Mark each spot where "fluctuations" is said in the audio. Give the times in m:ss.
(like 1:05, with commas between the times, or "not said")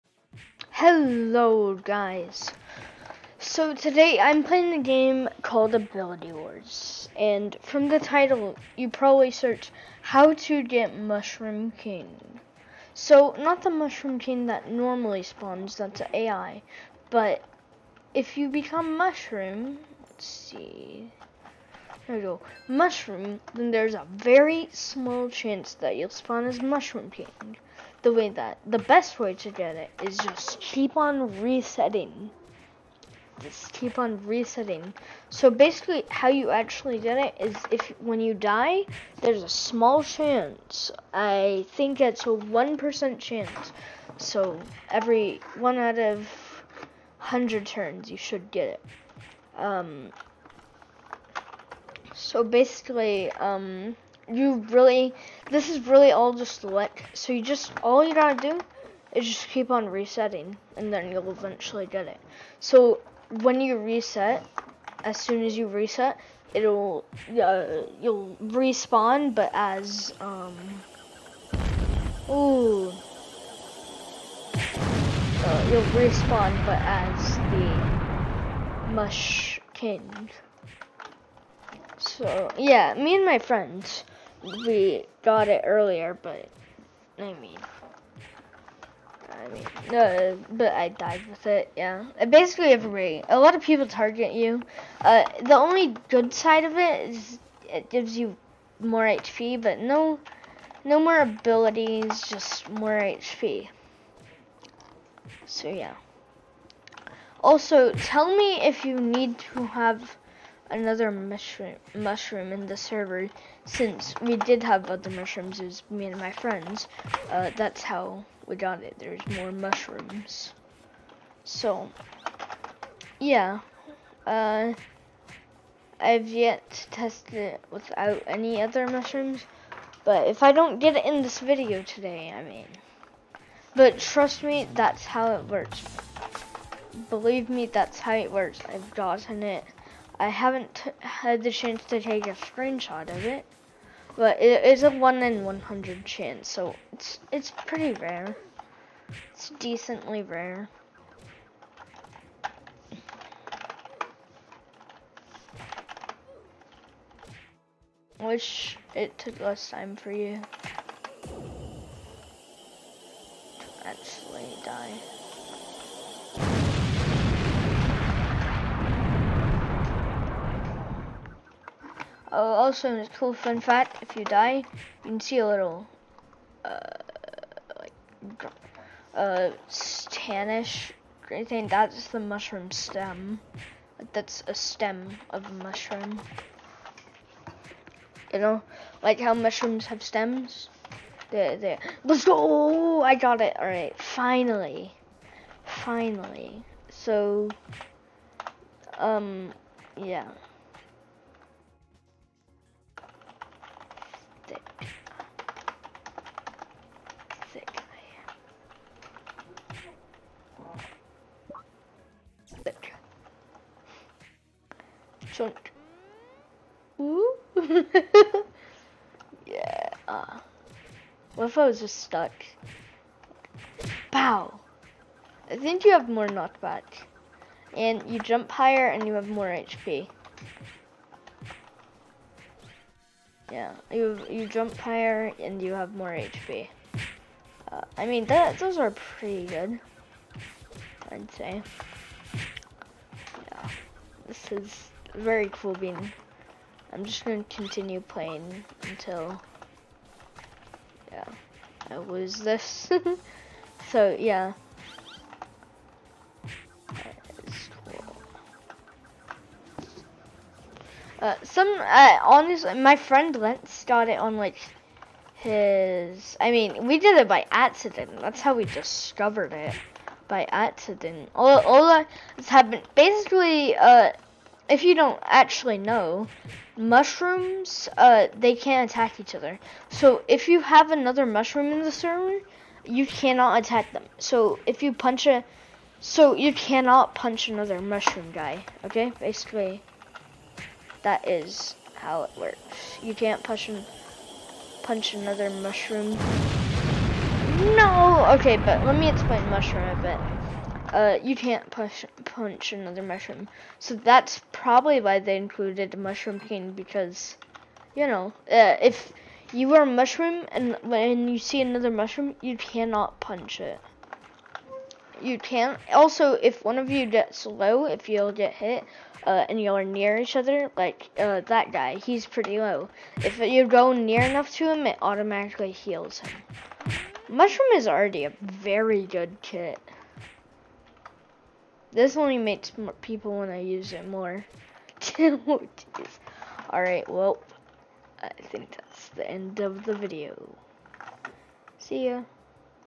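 not said.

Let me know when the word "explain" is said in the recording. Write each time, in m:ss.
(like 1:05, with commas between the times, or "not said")
4:59.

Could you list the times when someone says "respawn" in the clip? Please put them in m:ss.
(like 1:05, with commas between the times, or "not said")
1:08, 1:16.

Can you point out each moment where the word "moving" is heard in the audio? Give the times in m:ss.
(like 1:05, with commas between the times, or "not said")
not said.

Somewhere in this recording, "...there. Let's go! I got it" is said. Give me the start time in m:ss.
3:11.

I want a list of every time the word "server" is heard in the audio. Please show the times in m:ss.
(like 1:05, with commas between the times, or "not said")
1:52, 4:41.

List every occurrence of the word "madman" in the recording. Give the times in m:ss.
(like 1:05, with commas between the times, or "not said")
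not said.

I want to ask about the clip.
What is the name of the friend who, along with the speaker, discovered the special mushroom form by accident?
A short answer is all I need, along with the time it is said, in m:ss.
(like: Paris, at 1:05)
Lentz, at 4:23.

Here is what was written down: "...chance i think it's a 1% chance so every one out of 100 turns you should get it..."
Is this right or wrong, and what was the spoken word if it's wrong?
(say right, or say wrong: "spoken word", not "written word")
right.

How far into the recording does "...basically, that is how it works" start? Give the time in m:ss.
4:49.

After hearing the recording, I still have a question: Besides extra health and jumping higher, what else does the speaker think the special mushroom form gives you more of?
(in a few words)
Knockback.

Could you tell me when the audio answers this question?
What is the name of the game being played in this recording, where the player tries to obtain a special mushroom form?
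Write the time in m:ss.
0:05.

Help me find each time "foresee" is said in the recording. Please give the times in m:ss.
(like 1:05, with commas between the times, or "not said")
not said.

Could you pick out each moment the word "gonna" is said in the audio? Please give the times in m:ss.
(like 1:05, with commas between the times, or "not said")
4:07.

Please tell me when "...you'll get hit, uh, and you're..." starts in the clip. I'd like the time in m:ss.
5:18.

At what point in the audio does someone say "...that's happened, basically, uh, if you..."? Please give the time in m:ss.
4:32.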